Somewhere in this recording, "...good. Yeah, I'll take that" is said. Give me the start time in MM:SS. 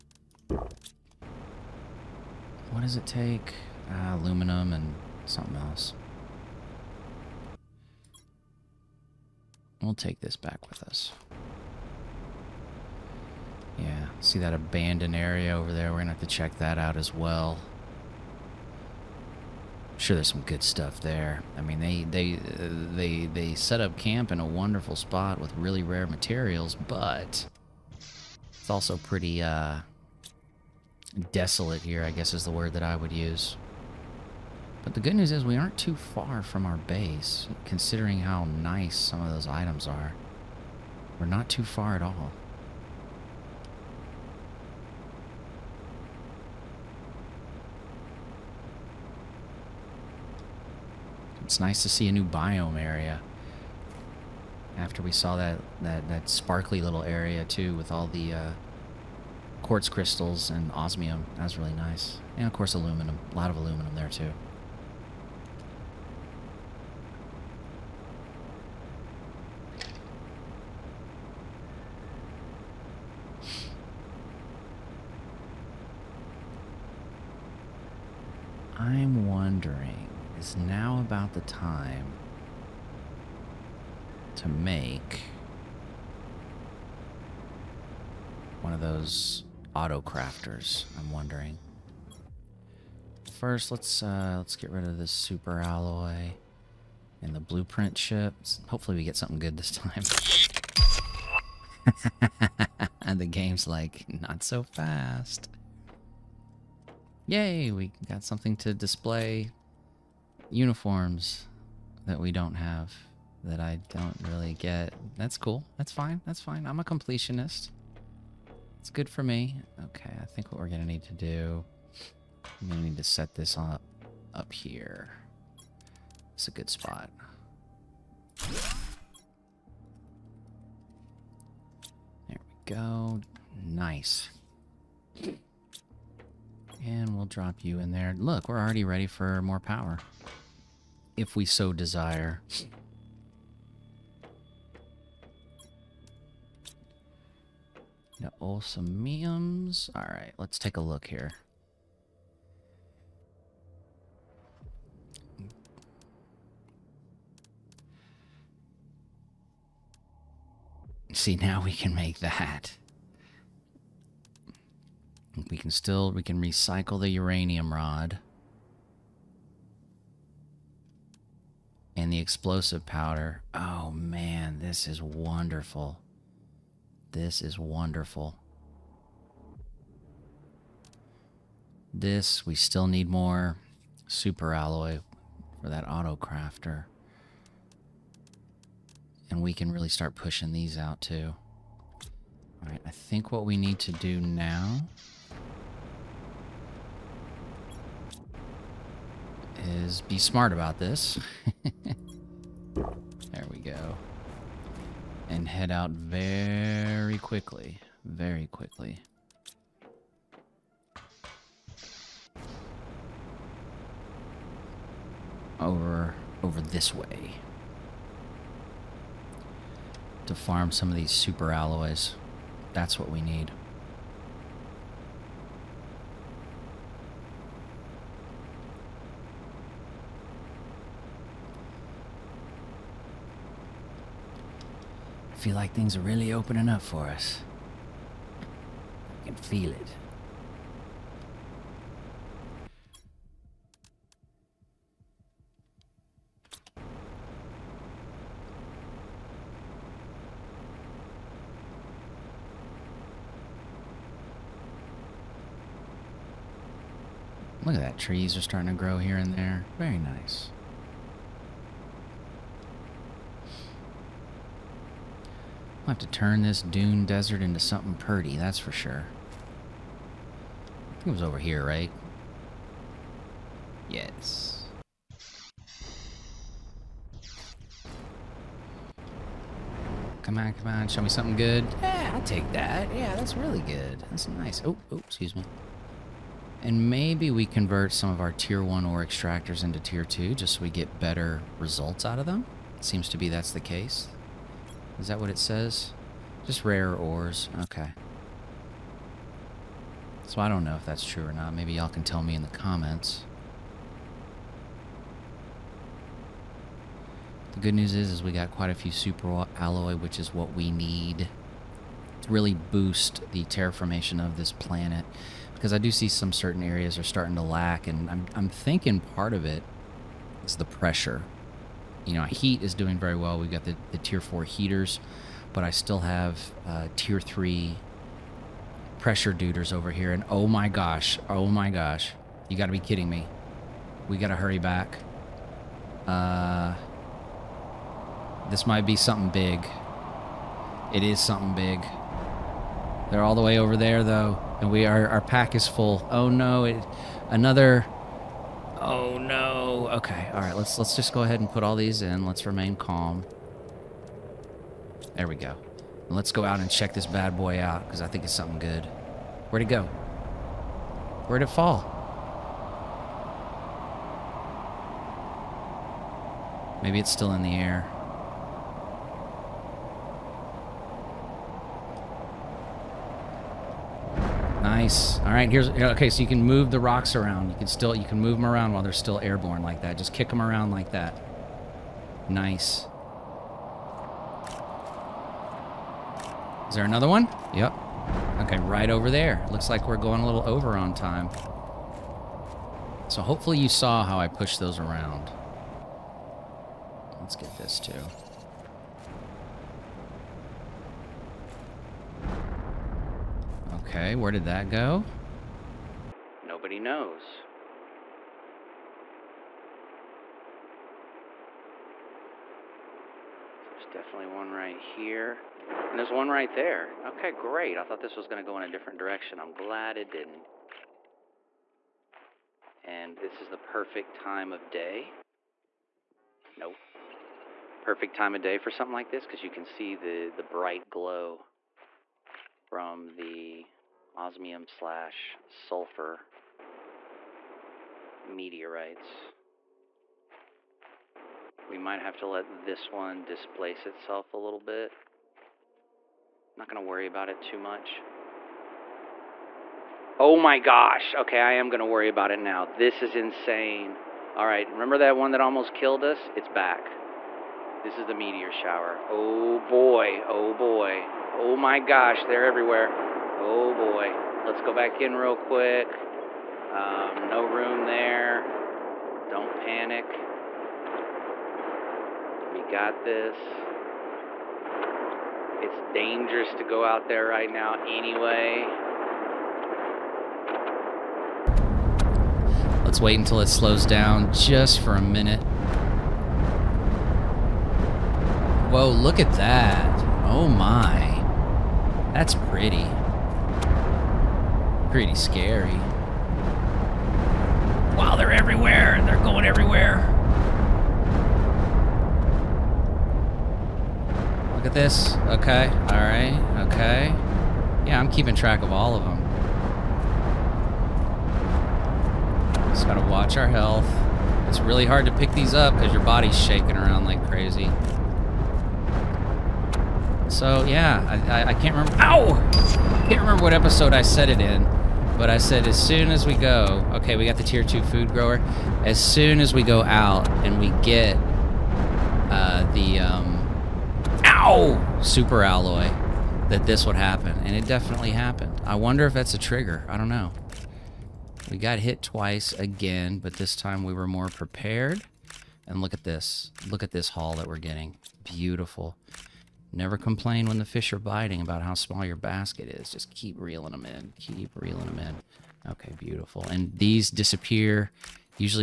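04:41.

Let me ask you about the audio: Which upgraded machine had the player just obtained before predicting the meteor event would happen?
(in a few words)
tier 2 food grower.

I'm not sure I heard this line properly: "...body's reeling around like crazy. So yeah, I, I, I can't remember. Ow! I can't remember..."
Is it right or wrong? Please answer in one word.
wrong.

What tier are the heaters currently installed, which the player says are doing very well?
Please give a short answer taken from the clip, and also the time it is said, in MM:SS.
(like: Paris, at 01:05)
4, at 05:23.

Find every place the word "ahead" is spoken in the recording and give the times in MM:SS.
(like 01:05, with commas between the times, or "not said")
05:51.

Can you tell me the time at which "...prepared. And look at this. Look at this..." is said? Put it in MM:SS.
09:04.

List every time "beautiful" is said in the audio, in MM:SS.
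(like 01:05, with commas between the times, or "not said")
09:08, 09:15.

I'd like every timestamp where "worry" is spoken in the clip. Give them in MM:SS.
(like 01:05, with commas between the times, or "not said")
07:26, 07:31.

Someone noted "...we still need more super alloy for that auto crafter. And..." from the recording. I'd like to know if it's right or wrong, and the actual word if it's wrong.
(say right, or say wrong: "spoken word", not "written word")
right.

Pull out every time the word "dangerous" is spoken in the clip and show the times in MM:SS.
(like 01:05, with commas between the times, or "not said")
07:55.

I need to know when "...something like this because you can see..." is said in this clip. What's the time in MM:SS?
07:08.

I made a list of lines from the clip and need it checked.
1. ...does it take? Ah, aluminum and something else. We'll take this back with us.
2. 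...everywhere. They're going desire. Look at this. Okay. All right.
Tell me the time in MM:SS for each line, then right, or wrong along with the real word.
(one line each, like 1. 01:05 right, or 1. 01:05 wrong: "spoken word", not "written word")
1. 00:02 right
2. 08:18 wrong: "everywhere", not "desire".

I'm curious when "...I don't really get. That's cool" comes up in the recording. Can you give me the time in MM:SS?
01:53.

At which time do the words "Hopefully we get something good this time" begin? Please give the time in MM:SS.
01:38.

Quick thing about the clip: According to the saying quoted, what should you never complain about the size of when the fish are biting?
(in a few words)
your basket.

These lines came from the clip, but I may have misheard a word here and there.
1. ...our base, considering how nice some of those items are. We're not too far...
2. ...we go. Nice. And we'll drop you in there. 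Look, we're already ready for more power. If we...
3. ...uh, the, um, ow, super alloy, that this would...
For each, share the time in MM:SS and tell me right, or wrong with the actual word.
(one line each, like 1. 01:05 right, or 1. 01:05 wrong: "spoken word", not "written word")
1. 00:36 right
2. 02:12 right
3. 08:52 right.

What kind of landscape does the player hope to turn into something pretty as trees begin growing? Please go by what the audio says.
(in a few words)
dune desert.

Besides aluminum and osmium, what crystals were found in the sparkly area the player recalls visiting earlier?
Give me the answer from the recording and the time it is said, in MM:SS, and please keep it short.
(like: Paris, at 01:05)
quartz crystals, at 00:59.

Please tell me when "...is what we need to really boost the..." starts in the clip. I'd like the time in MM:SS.
05:10.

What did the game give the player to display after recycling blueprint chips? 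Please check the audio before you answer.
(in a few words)
uniforms.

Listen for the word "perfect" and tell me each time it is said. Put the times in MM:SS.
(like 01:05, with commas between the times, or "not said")
07:03, 07:07.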